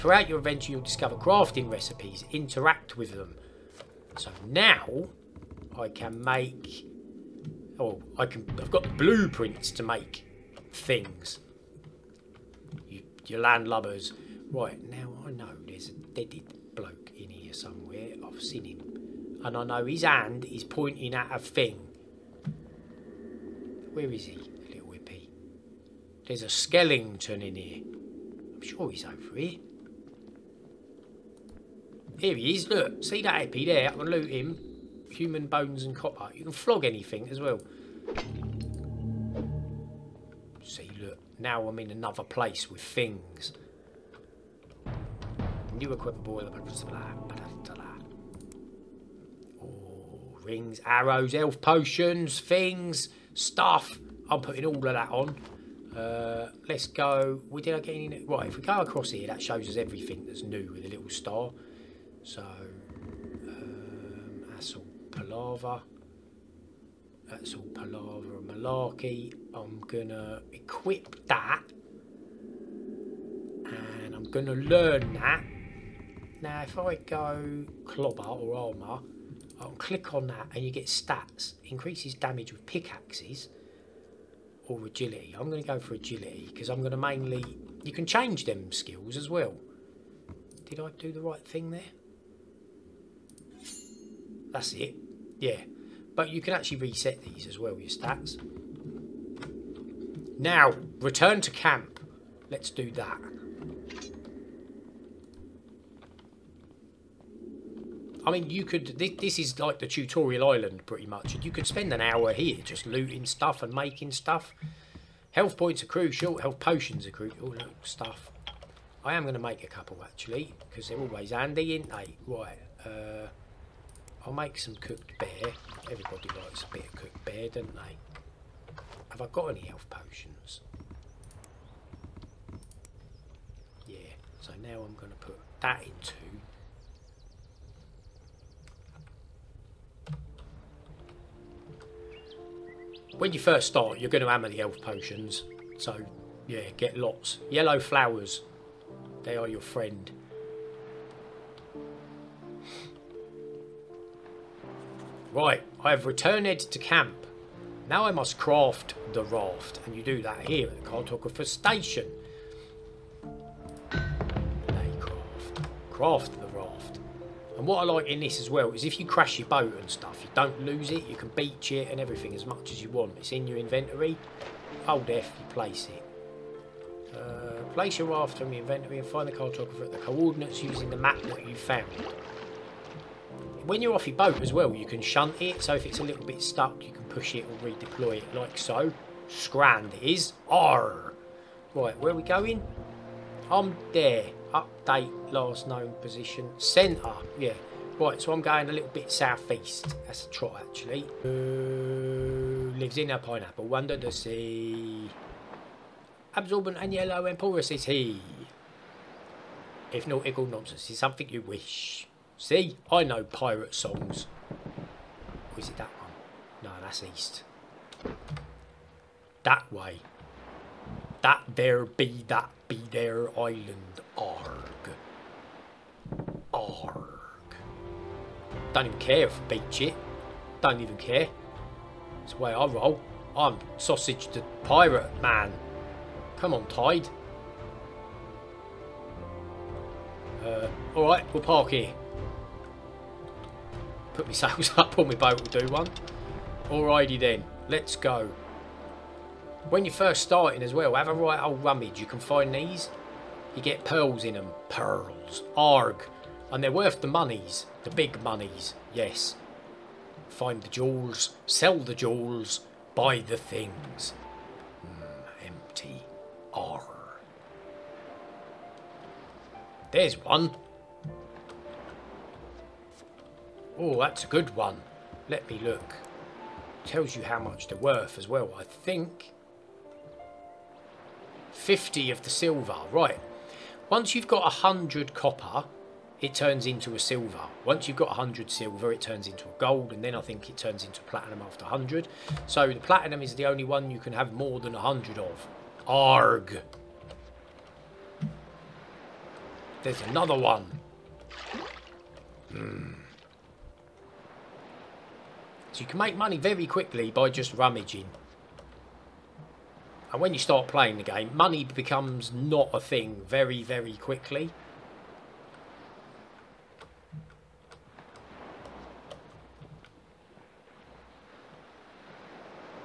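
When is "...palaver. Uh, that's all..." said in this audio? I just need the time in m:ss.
1:05.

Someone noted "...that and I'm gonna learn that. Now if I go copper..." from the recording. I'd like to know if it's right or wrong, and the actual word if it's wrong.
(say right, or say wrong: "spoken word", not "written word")
wrong: "clobber", not "copper".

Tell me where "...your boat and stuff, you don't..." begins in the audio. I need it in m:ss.
2:49.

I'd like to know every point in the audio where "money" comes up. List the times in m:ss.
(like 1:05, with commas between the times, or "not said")
5:06, 5:11.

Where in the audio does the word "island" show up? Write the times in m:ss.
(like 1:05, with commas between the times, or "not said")
1:50, 3:43.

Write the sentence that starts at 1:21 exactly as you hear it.
Increases damage with pickaxes or agility.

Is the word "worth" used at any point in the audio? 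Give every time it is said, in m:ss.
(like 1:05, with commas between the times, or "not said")
4:16, 4:37.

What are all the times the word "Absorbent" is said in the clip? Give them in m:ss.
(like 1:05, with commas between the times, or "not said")
3:26.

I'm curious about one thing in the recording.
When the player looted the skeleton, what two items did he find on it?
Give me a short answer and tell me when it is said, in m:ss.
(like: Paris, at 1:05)
Human bones and copper, at 0:35.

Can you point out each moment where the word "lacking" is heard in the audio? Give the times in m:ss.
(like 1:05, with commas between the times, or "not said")
not said.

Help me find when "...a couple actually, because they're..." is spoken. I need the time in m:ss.
1:59.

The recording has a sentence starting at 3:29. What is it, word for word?
If not, equal nonsense is something you wish.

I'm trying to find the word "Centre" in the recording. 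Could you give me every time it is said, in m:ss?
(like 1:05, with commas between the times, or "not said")
3:16.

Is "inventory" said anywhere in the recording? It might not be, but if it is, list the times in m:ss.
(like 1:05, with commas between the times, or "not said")
2:53, 2:58.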